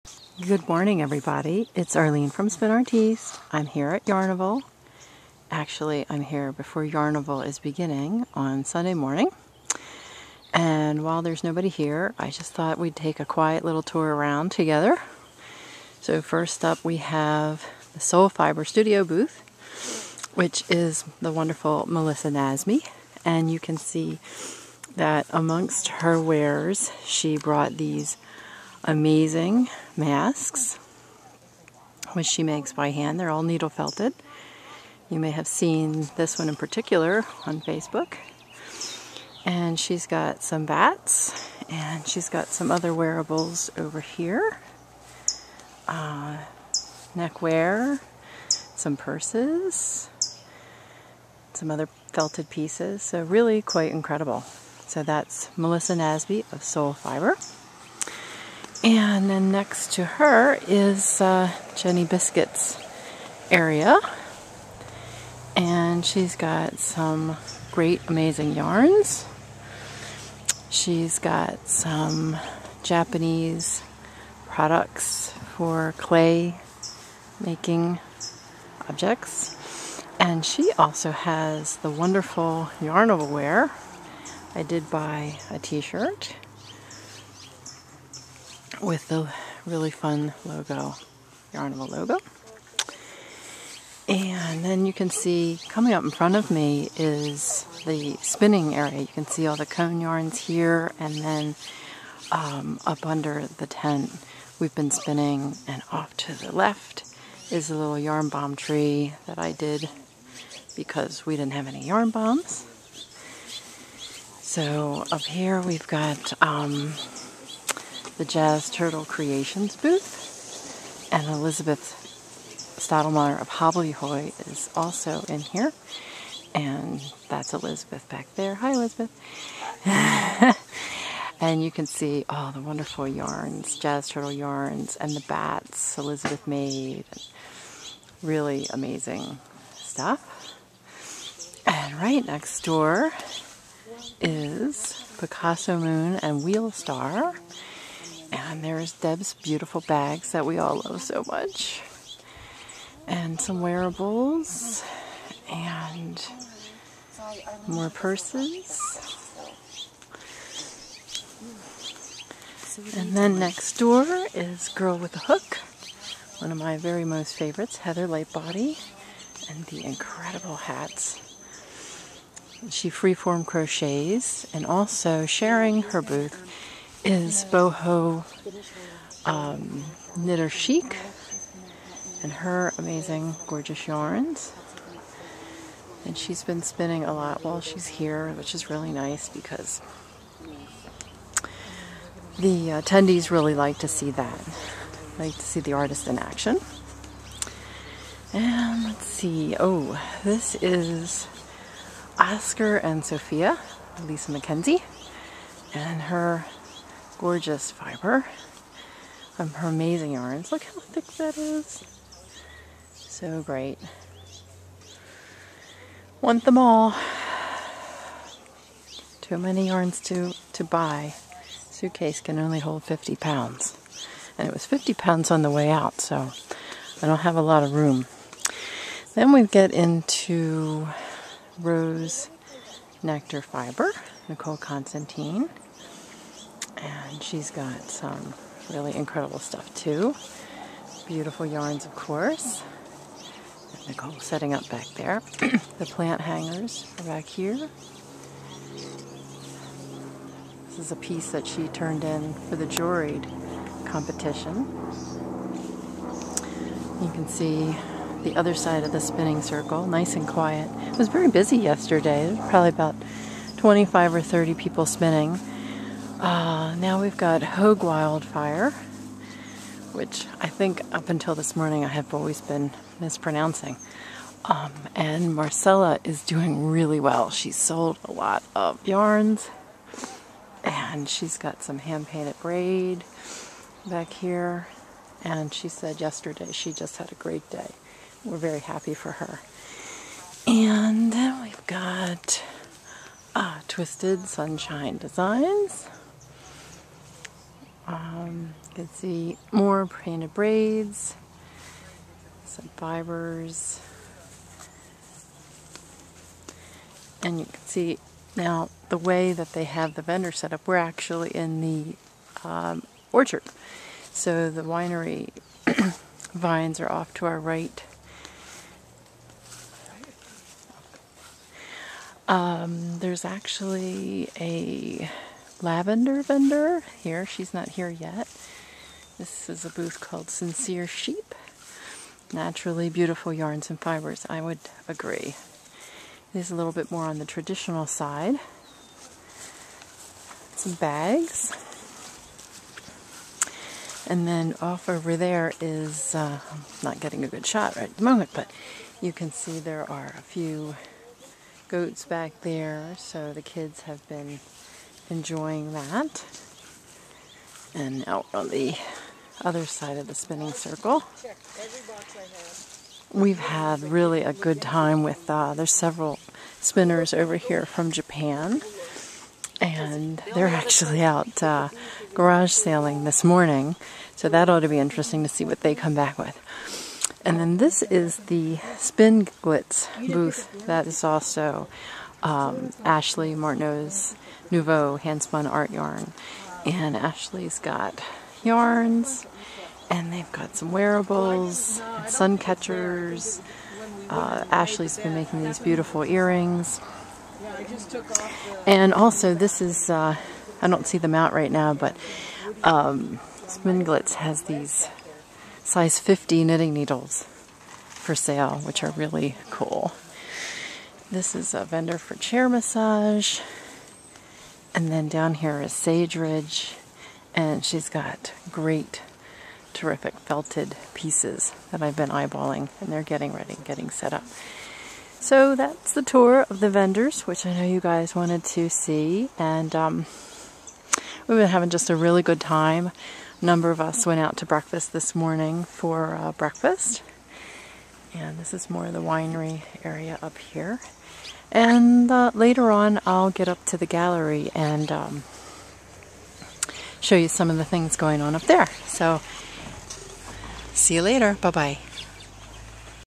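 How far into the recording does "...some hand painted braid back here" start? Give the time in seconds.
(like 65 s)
281 s.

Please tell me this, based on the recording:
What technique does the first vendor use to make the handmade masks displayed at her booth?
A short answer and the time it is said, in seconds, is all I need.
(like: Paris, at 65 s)
Needle felted, at 33 s.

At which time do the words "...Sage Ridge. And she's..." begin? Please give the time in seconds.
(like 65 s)
415 s.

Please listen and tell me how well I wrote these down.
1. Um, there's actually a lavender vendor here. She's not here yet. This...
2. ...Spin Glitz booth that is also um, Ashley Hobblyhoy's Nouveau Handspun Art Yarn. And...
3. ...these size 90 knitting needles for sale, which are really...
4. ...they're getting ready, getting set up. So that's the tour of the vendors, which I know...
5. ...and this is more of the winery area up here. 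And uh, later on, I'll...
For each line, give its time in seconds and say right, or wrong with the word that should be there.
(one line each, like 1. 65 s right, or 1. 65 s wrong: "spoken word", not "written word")
1. 322 s right
2. 378 s wrong: "Martineau", not "Hobblyhoy"
3. 404 s wrong: "50", not "90"
4. 422 s right
5. 438 s right.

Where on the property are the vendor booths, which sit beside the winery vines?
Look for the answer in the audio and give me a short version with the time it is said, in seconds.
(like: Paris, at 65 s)
Orchard, at 313 s.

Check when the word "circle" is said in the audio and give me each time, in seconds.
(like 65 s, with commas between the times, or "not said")
259 s, 360 s.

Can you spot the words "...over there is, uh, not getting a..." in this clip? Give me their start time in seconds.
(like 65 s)
344 s.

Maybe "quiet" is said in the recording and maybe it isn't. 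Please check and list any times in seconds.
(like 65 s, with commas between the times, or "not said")
13 s, 260 s.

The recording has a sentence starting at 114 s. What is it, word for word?
So up here, we've got um, the Jazz Turtle Creations booth.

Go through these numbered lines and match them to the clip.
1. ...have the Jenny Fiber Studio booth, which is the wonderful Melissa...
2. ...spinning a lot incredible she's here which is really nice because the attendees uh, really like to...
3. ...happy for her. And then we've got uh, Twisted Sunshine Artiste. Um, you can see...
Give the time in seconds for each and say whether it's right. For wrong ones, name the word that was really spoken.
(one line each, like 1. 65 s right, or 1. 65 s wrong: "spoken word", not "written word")
1. 16 s wrong: "Soul", not "Jenny"
2. 186 s wrong: "while", not "incredible"
3. 288 s wrong: "Designs", not "Artiste".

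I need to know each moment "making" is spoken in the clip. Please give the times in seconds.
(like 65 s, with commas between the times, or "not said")
77 s, 395 s.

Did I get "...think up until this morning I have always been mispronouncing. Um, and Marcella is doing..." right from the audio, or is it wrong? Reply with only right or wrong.
right.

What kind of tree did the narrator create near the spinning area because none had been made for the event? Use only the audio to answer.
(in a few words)
Yarn bomb tree.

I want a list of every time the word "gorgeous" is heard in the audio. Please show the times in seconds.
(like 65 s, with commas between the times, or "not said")
183 s, 207 s.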